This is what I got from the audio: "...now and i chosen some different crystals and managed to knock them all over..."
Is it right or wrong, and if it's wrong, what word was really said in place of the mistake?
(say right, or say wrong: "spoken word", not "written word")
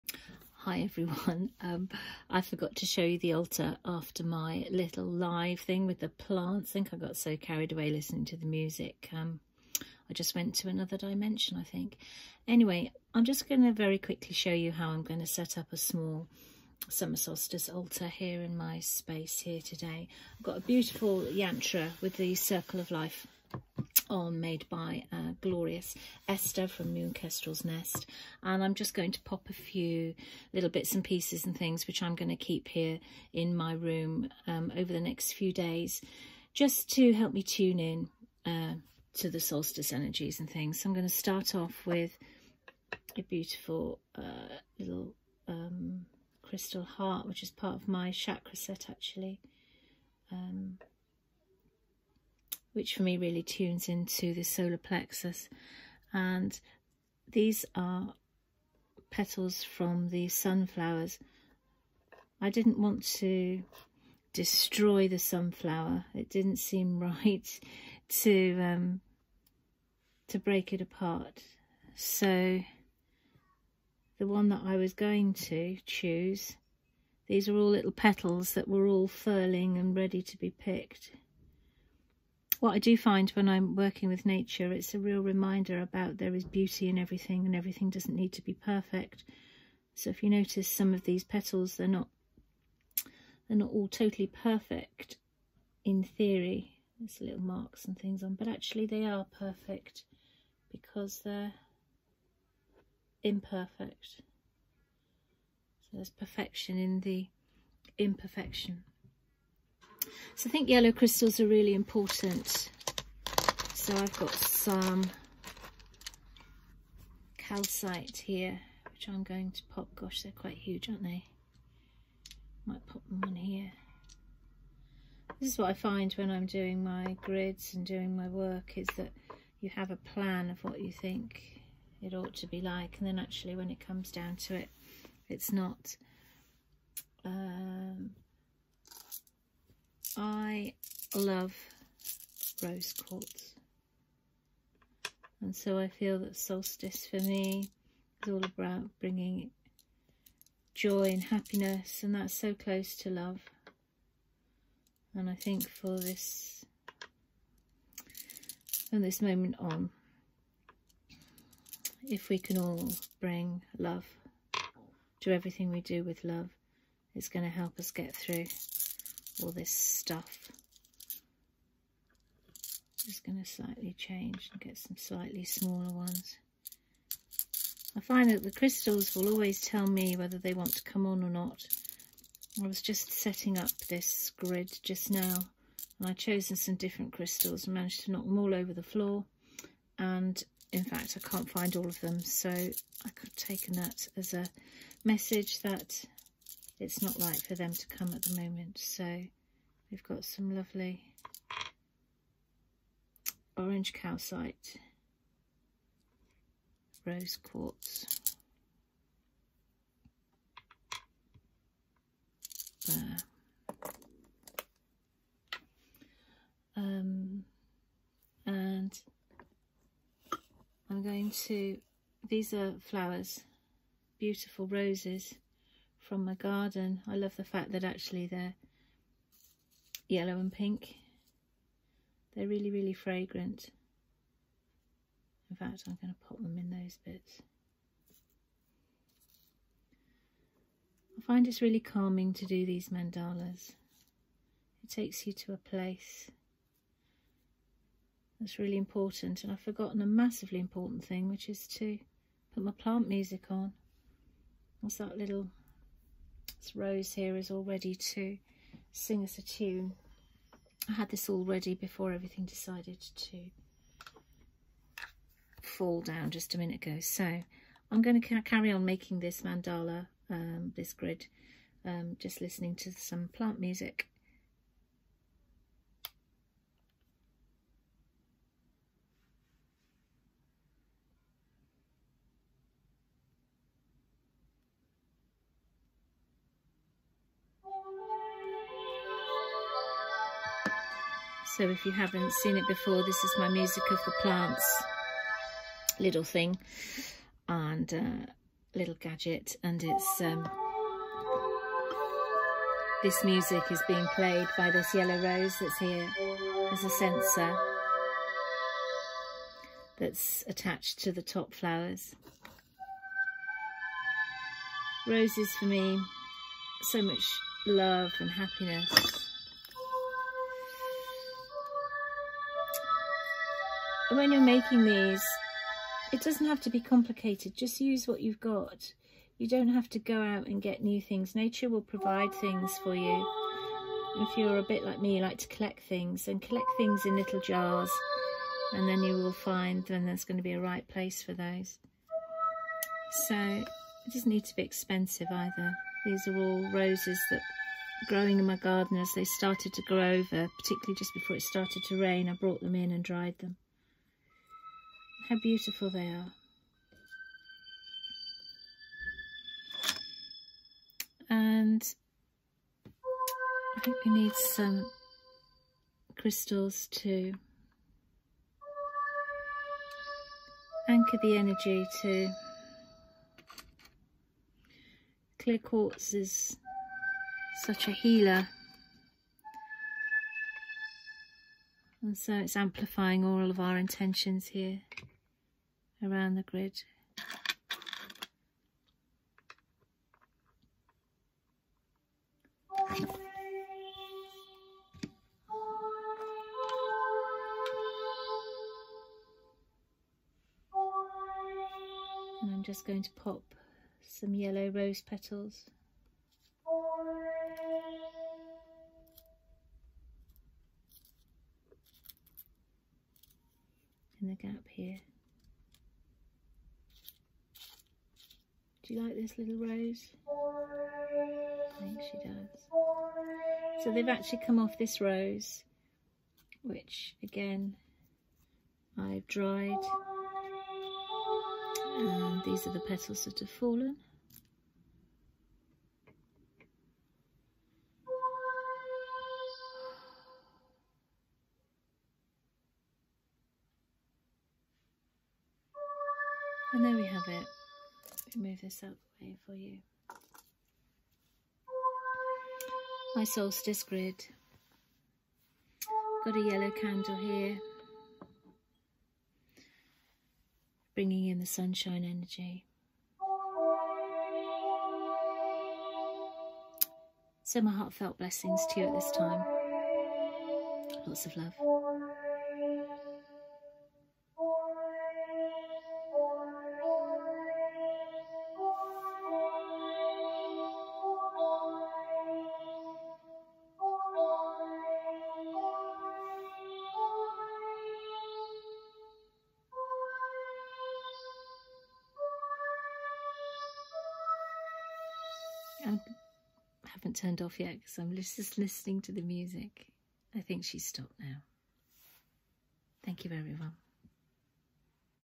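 right.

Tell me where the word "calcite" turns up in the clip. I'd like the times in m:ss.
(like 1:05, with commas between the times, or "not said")
1:57, 3:23.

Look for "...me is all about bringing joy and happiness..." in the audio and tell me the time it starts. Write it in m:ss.
2:27.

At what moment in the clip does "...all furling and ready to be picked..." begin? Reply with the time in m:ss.
1:18.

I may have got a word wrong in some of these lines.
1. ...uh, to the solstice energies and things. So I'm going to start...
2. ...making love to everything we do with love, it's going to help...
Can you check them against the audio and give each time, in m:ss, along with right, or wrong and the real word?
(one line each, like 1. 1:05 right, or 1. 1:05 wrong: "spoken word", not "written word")
1. 0:38 right
2. 2:43 wrong: "bring", not "making".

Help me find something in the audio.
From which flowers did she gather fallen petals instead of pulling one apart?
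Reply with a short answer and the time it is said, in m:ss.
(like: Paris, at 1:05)
sunflowers, at 1:00.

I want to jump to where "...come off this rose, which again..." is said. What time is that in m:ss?
7:04.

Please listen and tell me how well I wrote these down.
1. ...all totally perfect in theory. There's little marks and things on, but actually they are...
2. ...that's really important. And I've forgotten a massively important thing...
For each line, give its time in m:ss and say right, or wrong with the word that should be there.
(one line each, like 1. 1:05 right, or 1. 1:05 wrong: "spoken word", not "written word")
1. 1:33 right
2. 4:08 right.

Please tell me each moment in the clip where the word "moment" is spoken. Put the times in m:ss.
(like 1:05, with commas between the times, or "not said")
2:39, 3:18.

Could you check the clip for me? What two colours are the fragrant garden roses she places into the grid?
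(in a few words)
yellow and pink.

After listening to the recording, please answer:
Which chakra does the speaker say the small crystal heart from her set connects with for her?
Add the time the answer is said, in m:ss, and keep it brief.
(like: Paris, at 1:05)
solar plexus, at 0:54.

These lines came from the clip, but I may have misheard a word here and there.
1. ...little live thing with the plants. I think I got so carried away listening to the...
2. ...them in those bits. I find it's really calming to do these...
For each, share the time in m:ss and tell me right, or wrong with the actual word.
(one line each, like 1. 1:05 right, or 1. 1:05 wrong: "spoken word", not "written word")
1. 0:04 right
2. 3:56 right.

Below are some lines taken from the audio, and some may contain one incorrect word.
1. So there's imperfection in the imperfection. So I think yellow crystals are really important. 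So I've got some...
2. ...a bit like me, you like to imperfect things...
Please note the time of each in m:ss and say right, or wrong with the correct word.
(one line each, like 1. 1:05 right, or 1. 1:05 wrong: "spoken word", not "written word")
1. 1:45 wrong: "perfection", not "imperfection"
2. 5:34 wrong: "collect", not "imperfect".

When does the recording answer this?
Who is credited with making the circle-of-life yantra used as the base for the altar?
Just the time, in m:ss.
0:25.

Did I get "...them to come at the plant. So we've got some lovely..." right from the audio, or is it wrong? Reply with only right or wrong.
wrong.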